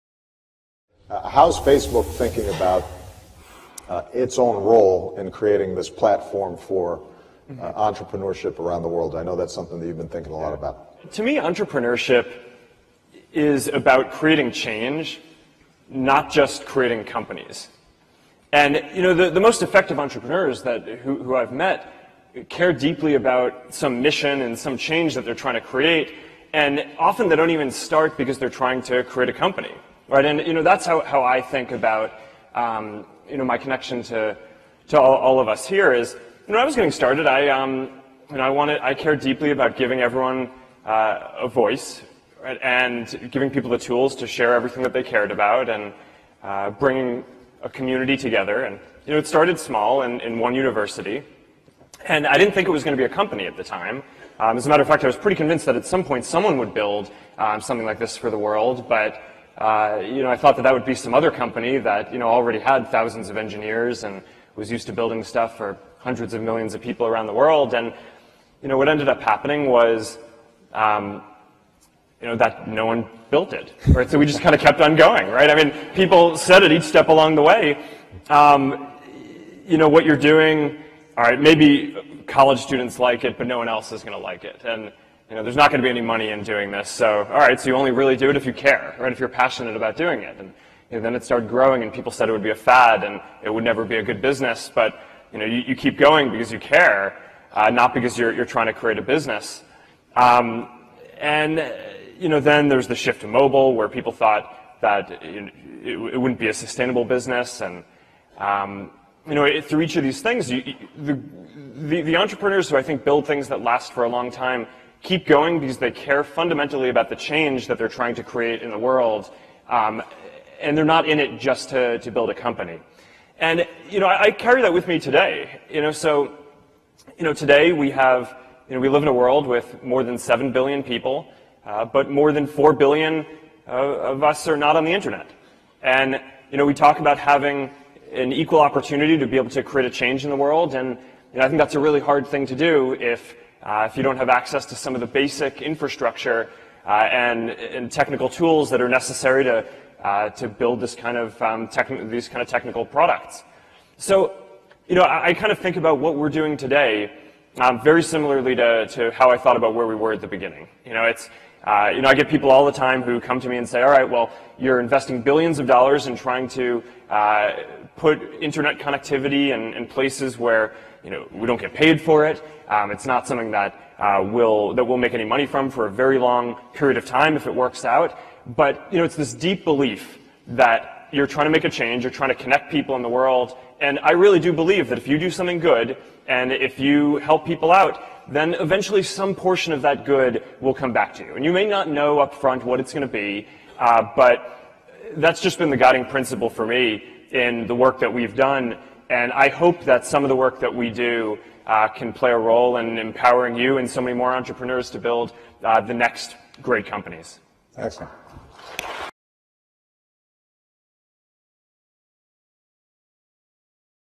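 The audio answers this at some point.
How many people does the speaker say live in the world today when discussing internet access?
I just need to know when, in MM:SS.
02:09.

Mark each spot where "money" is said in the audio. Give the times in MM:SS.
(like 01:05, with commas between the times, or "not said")
01:26, 02:55.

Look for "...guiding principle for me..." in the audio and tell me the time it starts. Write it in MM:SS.
03:15.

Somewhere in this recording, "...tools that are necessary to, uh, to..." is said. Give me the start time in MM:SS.
02:28.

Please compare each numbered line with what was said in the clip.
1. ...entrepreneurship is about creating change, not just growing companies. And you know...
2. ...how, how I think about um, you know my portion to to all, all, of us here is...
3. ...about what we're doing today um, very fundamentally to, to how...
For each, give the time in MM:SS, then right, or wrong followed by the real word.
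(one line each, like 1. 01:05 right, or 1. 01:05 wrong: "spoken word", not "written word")
1. 00:11 wrong: "creating", not "growing"
2. 00:30 wrong: "connection", not "portion"
3. 02:35 wrong: "similarly", not "fundamentally".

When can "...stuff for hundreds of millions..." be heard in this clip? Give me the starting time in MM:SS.
01:05.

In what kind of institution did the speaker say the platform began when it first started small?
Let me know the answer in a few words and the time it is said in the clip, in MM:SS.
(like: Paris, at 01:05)
one university, at 00:50.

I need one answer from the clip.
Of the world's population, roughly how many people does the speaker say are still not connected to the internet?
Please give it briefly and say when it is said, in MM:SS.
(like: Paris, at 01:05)
more than 4 billion, at 02:12.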